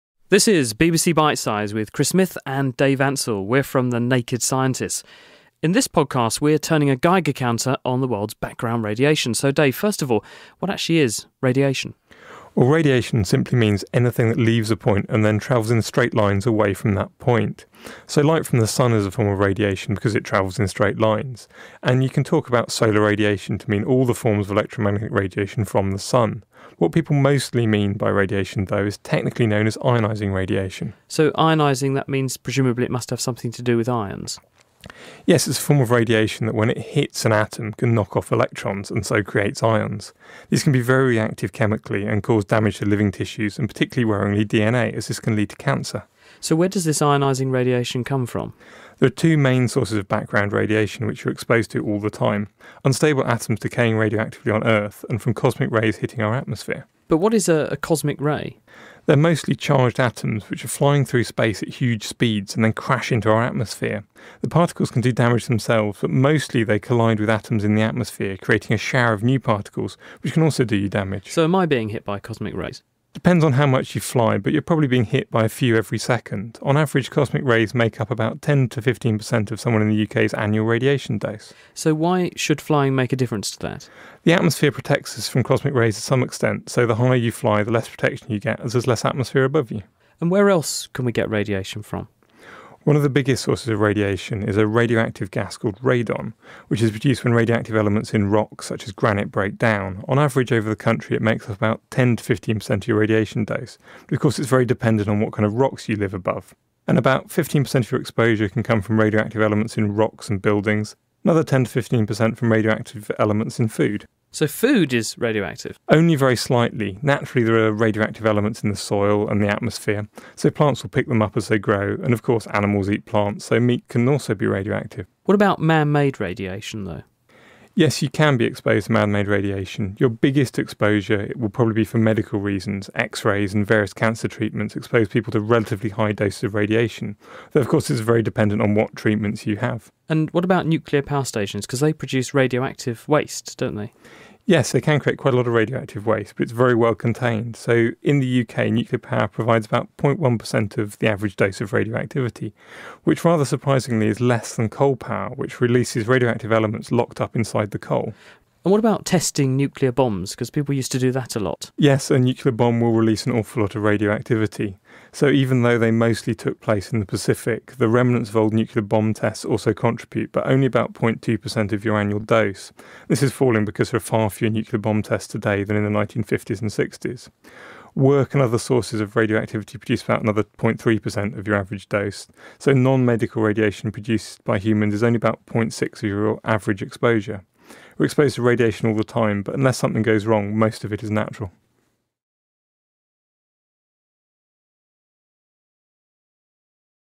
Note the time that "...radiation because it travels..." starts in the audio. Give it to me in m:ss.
0:19.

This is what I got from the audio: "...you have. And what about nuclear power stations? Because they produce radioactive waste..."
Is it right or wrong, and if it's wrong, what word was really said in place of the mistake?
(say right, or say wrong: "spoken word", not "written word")
right.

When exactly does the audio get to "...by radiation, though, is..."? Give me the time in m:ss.
0:27.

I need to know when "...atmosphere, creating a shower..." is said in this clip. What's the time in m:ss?
1:07.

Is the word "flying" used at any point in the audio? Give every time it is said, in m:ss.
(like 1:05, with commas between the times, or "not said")
1:00, 1:22.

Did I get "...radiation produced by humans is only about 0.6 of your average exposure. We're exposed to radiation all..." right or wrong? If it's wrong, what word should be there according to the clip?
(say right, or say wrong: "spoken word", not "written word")
right.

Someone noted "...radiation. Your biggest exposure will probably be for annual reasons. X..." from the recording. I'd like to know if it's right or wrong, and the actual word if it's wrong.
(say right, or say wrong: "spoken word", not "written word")
wrong: "medical", not "annual".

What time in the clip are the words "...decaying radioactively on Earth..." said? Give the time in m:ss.
0:53.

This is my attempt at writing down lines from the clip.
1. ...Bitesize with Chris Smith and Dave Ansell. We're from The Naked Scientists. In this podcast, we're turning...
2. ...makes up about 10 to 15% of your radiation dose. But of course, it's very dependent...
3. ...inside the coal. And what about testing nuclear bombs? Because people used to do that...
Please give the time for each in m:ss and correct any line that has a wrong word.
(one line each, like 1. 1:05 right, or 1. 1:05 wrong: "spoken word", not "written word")
1. 0:01 right
2. 1:41 right
3. 2:37 right.